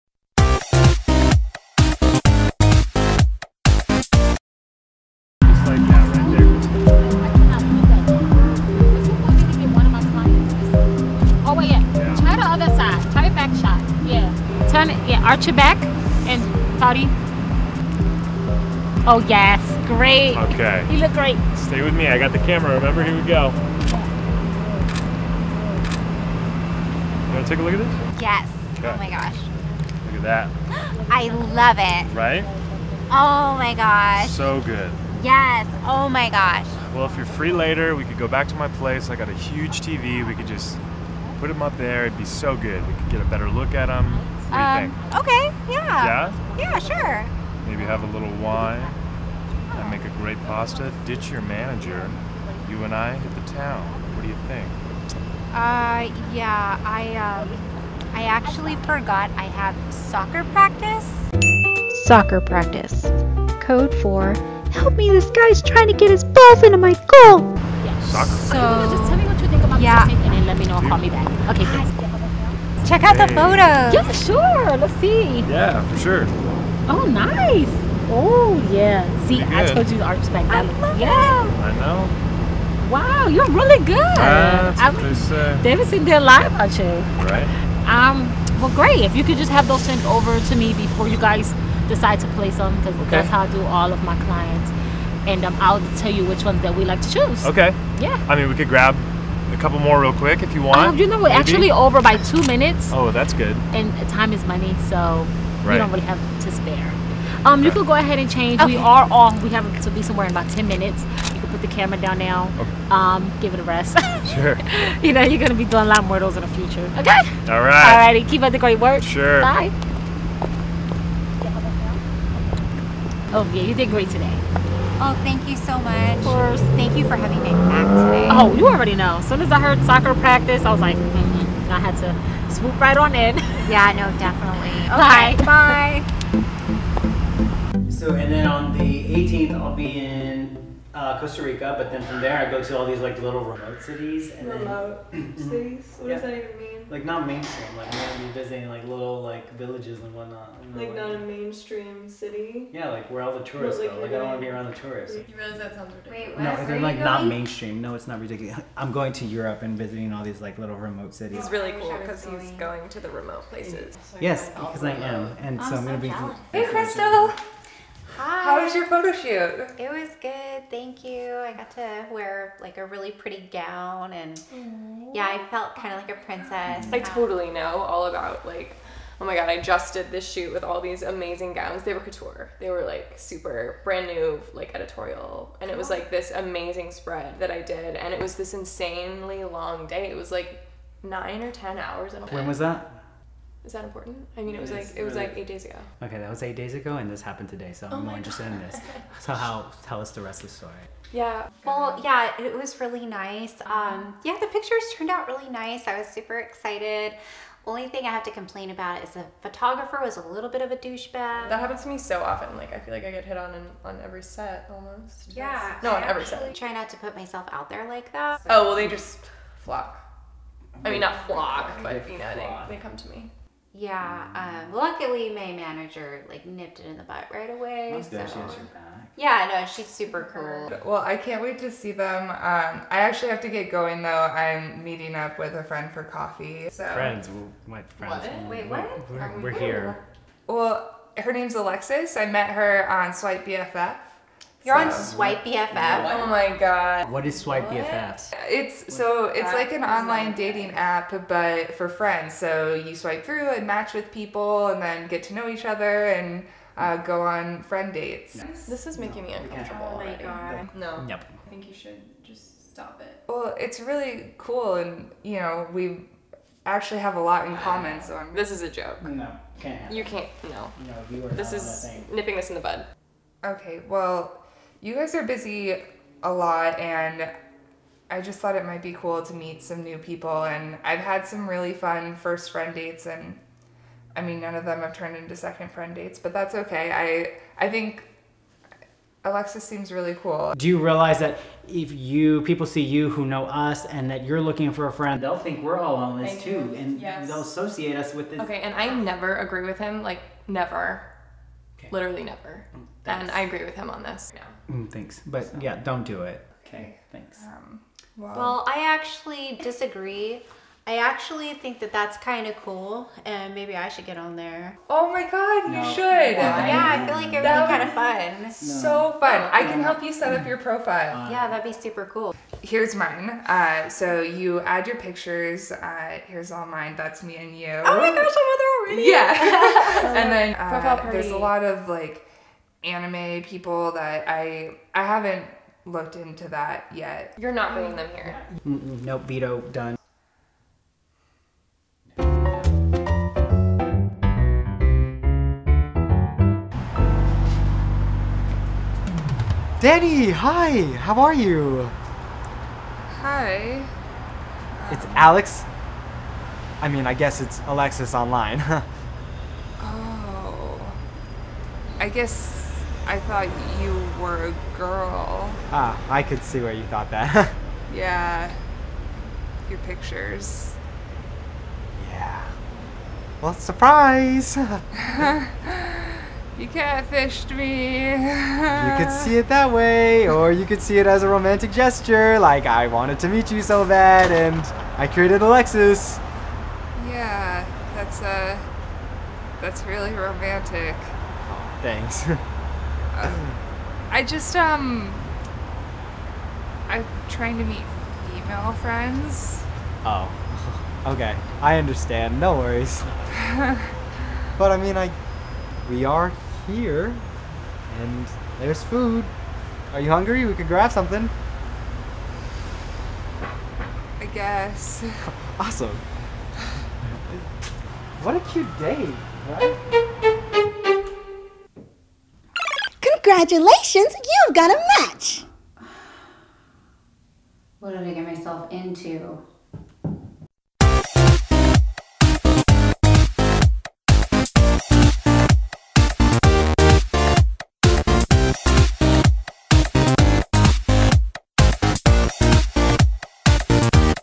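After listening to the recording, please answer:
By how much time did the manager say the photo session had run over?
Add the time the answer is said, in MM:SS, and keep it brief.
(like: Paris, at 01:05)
2 minutes, at 01:42.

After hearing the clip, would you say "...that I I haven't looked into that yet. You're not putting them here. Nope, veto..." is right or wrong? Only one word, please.
right.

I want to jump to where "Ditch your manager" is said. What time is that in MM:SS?
00:51.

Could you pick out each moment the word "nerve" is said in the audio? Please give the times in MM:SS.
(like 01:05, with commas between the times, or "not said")
not said.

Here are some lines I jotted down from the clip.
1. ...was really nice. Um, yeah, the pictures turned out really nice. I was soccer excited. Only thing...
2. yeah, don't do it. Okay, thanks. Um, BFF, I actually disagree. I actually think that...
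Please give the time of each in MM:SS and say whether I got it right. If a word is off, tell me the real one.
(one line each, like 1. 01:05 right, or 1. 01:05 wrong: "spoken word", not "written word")
1. 03:22 wrong: "super", not "soccer"
2. 05:05 wrong: "Well", not "BFF".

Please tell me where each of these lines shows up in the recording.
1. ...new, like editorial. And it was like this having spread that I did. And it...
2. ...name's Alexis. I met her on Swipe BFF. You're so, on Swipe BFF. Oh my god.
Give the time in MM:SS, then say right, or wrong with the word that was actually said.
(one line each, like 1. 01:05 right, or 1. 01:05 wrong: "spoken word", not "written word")
1. 03:04 wrong: "amazing", not "having"
2. 04:01 right.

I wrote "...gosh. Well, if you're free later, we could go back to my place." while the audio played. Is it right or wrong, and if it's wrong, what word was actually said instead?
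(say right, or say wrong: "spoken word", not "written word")
right.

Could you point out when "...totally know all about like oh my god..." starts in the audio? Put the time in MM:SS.
02:56.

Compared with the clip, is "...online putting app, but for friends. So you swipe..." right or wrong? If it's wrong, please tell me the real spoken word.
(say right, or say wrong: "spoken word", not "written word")
wrong: "dating", not "putting".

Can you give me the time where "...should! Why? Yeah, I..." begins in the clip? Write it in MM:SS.
05:15.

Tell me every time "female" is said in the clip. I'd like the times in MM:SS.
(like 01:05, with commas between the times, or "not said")
06:38.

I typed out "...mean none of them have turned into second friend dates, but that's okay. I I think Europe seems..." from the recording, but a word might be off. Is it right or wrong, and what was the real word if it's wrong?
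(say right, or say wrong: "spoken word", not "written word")
wrong: "Alexis", not "Europe".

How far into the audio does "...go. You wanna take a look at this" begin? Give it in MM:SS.
00:23.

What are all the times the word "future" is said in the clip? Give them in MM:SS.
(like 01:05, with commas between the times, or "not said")
01:56.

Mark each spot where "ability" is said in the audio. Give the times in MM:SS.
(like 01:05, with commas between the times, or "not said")
not said.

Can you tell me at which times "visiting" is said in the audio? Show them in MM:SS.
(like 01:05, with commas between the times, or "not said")
02:28, 02:39.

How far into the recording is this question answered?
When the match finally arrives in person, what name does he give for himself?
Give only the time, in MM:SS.
05:55.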